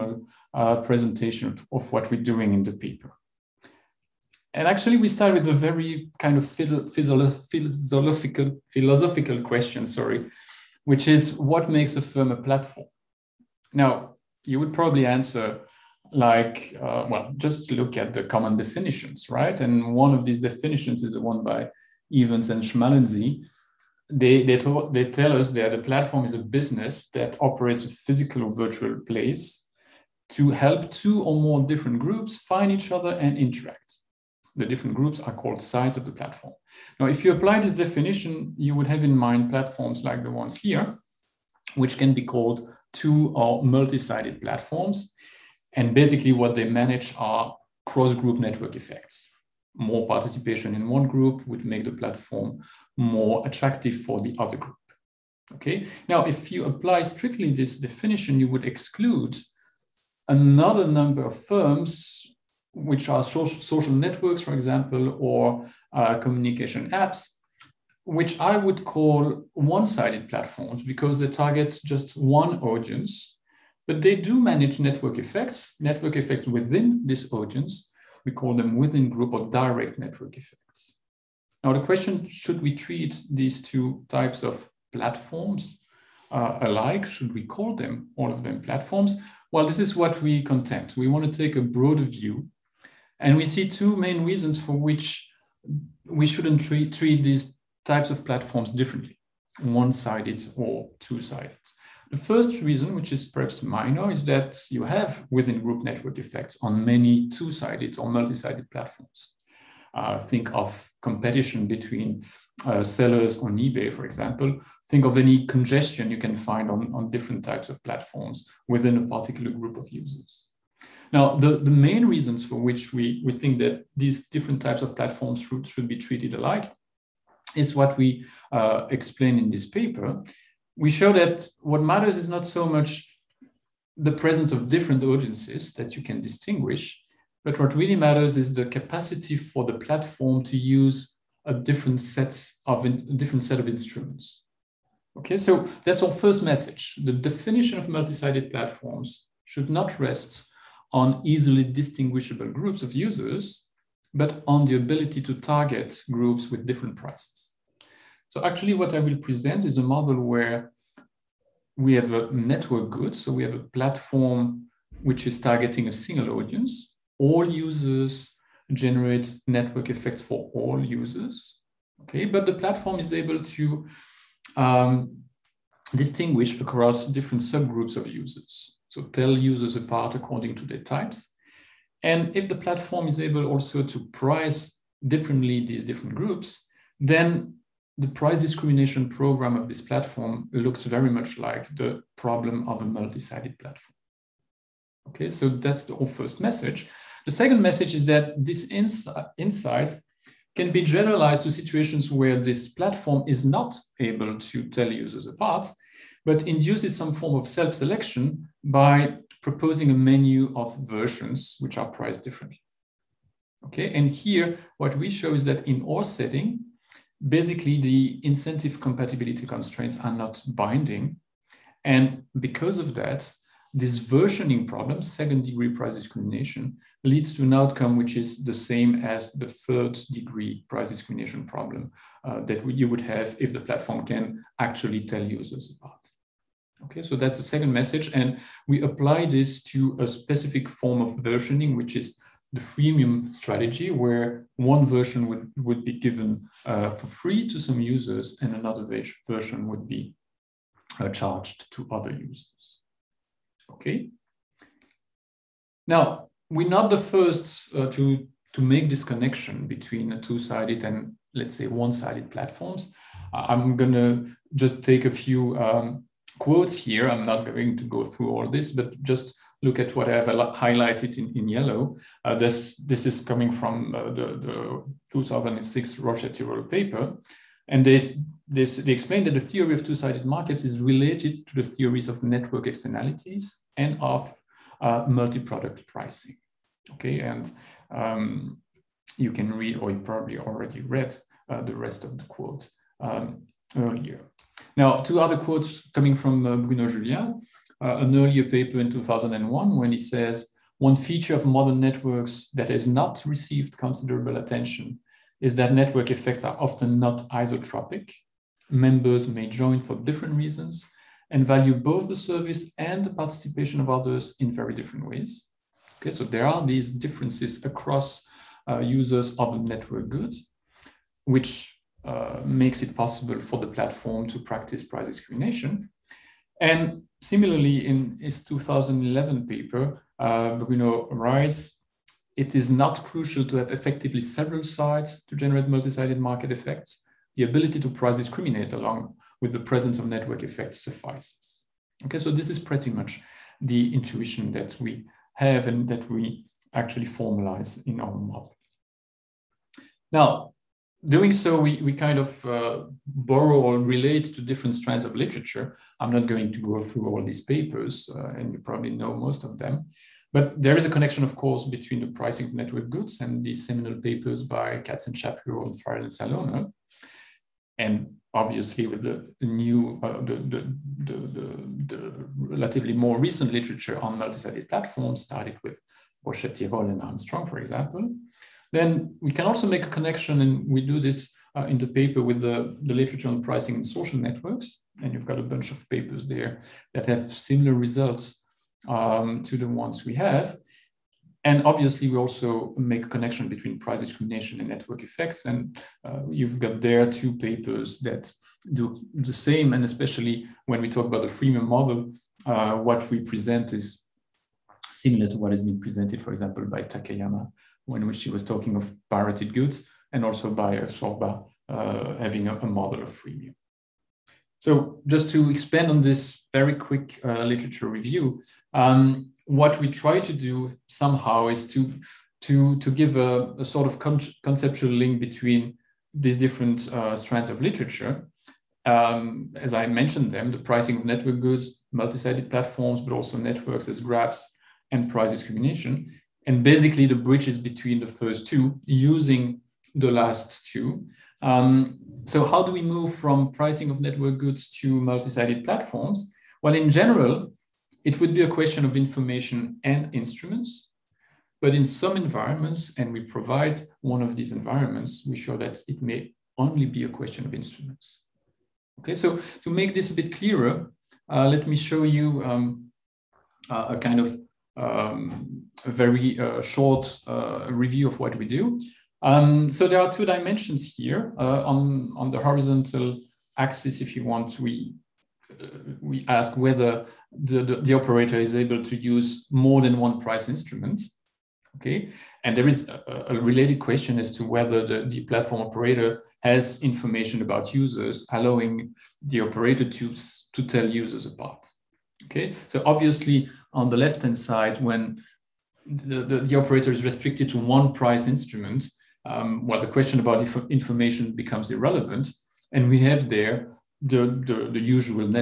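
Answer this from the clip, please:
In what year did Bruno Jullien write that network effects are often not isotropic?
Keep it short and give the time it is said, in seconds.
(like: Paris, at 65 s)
2001, at 298 s.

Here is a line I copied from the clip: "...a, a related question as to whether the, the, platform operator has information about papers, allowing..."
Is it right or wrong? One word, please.
wrong.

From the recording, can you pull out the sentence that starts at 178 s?
So tell users apart according to their types.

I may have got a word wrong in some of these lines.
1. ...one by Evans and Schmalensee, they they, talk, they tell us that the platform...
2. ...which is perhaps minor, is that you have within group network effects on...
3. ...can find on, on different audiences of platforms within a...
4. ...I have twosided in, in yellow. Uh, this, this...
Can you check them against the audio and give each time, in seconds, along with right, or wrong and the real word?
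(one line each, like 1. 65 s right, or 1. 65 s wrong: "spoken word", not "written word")
1. 21 s right
2. 102 s right
3. 116 s wrong: "types", not "audiences"
4. 270 s wrong: "highlighted", not "twosided".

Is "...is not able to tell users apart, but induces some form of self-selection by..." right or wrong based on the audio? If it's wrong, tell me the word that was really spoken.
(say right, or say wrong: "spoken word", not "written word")
right.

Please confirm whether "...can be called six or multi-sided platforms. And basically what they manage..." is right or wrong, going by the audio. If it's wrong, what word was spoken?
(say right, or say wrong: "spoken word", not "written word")
wrong: "two", not "six".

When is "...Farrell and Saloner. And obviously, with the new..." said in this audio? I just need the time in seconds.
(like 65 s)
365 s.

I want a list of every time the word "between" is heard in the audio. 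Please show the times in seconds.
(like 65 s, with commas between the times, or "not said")
111 s, 259 s, 361 s, 393 s, 425 s, 437 s.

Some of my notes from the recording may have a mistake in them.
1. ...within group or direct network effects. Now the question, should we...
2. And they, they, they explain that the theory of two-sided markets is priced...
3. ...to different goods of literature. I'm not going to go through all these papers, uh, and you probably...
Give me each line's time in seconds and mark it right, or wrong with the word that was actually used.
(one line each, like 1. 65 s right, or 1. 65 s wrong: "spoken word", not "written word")
1. 78 s right
2. 277 s wrong: "related", not "priced"
3. 354 s wrong: "strands", not "goods".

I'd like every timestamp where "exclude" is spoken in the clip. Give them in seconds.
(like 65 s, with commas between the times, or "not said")
58 s.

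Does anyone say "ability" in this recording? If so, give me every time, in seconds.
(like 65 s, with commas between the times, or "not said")
154 s, 337 s.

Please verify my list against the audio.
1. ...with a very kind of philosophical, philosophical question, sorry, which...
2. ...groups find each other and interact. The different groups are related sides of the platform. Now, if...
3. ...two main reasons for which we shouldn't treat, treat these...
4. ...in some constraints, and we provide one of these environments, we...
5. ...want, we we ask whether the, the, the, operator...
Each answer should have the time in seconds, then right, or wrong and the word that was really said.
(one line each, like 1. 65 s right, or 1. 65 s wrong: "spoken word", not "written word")
1. 5 s right
2. 31 s wrong: "called", not "related"
3. 93 s right
4. 451 s wrong: "environments", not "constraints"
5. 474 s right.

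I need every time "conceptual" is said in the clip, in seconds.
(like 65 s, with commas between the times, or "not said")
424 s.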